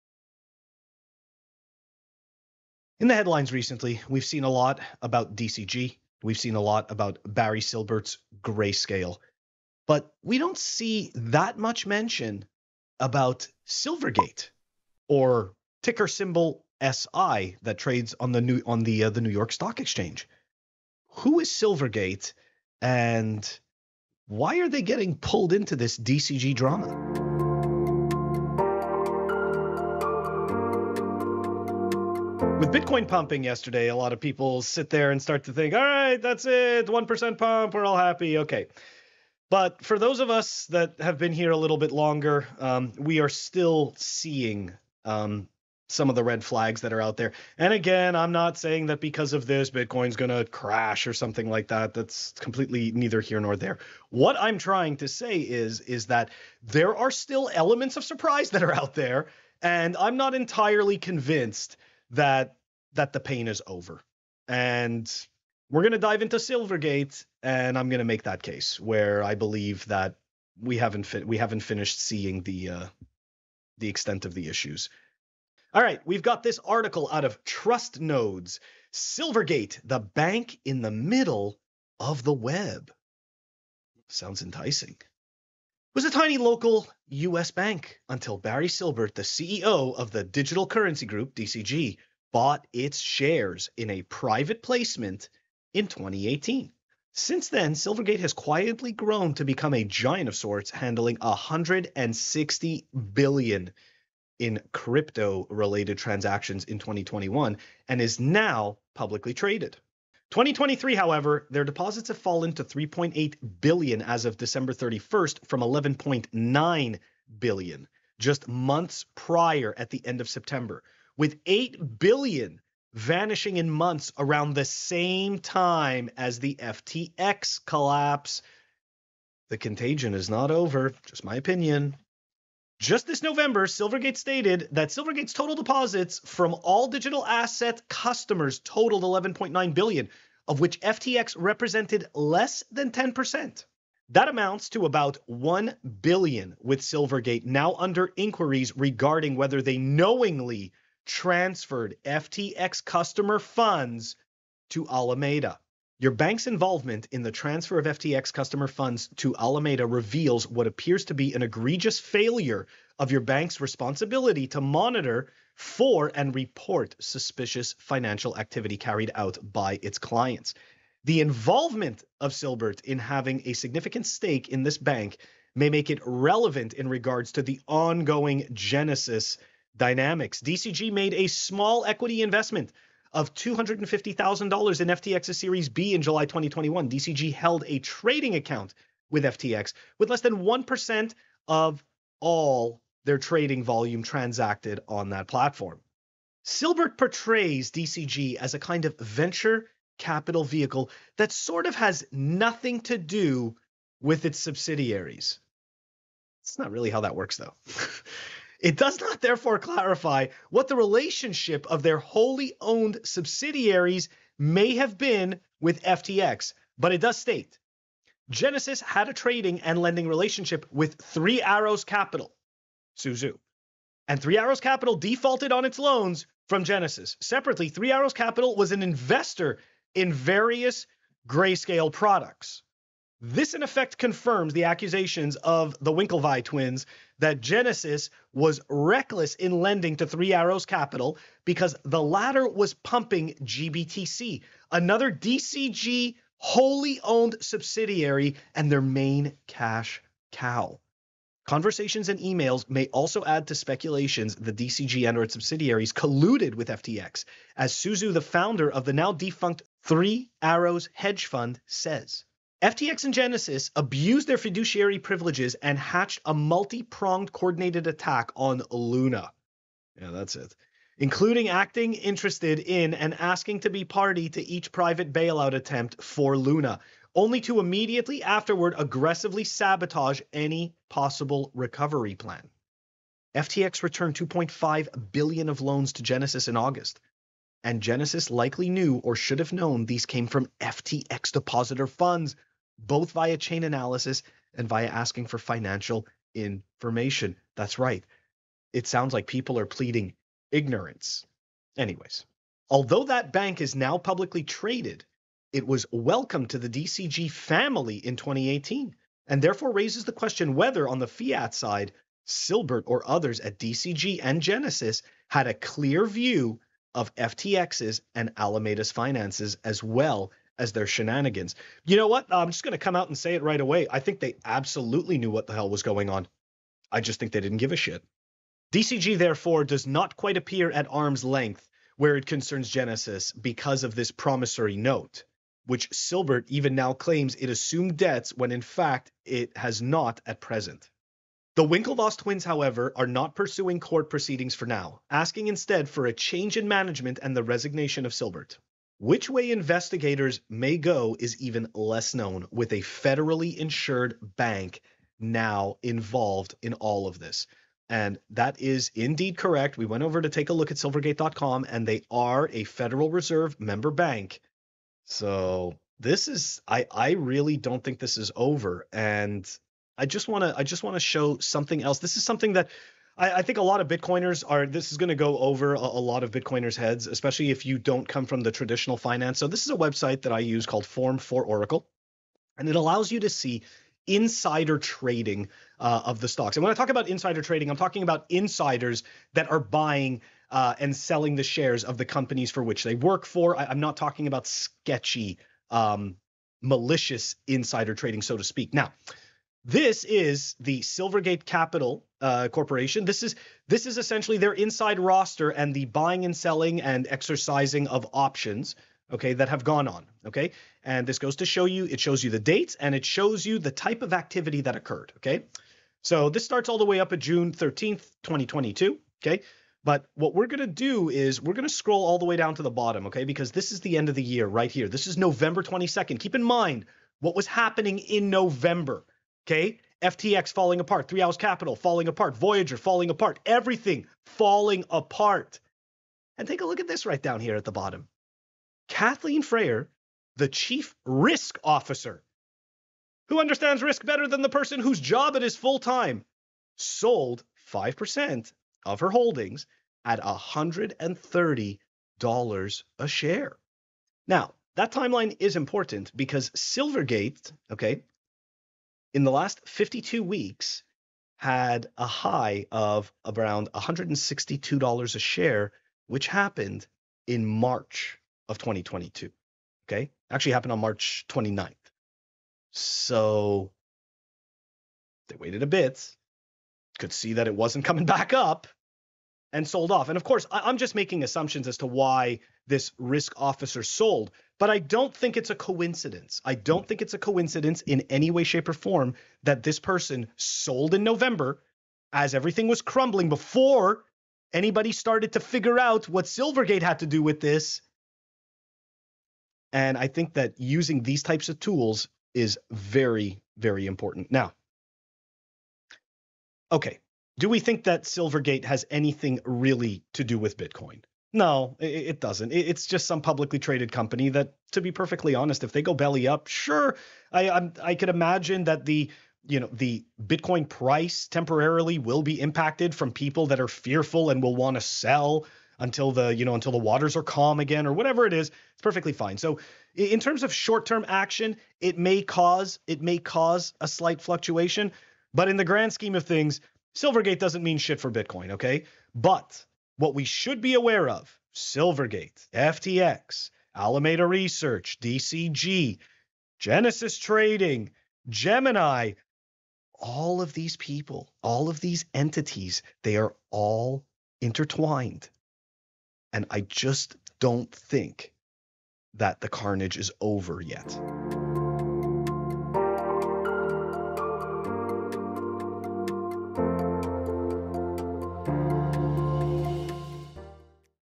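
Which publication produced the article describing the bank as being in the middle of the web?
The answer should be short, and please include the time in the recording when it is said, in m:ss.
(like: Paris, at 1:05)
Trust Nodes, at 1:17.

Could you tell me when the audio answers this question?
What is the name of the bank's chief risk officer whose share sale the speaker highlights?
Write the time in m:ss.
7:18.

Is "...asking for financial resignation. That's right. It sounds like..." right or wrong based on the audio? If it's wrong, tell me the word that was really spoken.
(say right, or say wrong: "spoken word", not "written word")
wrong: "information", not "resignation".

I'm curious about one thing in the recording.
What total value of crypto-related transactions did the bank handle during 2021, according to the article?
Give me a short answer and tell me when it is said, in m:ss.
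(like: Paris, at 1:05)
$160 billion, at 1:41.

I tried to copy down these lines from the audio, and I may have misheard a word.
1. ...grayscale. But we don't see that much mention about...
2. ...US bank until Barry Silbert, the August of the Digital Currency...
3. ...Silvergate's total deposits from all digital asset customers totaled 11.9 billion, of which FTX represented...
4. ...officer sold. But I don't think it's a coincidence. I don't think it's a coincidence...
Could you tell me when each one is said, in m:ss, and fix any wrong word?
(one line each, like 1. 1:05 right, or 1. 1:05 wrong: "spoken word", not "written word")
1. 0:08 right
2. 1:27 wrong: "CEO", not "August"
3. 2:14 right
4. 8:03 right.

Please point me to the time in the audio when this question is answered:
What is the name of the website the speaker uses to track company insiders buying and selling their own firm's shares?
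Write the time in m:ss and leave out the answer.
6:20.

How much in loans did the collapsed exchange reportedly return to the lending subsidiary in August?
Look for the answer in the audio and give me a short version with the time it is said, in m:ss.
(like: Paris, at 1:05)
$2.5 billion, at 4:44.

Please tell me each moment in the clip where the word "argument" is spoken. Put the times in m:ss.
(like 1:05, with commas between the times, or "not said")
not said.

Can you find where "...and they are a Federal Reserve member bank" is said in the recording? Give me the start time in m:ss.
6:01.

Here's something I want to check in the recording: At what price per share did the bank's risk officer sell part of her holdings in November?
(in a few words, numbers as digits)
$130.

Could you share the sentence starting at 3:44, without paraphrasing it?
And Three Arrows Capital defaulted on its loans from Genesis.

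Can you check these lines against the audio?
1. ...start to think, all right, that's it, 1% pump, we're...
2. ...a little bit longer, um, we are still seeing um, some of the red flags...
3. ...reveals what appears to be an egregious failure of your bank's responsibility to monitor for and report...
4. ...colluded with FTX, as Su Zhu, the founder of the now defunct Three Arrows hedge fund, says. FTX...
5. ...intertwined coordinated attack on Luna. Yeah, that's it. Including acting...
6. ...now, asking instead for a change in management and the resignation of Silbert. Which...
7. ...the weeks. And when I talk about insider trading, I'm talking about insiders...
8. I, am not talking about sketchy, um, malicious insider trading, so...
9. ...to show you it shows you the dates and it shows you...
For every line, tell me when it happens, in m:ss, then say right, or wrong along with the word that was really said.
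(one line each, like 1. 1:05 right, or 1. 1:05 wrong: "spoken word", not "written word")
1. 0:35 right
2. 0:41 right
3. 2:39 right
4. 4:15 right
5. 4:26 wrong: "pronged", not "intertwined"
6. 5:44 right
7. 6:26 wrong: "stocks", not "weeks"
8. 6:33 right
9. 6:51 right.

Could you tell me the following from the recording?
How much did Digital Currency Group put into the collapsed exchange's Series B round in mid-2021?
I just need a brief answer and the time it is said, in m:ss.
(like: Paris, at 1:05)
$250,000, at 3:03.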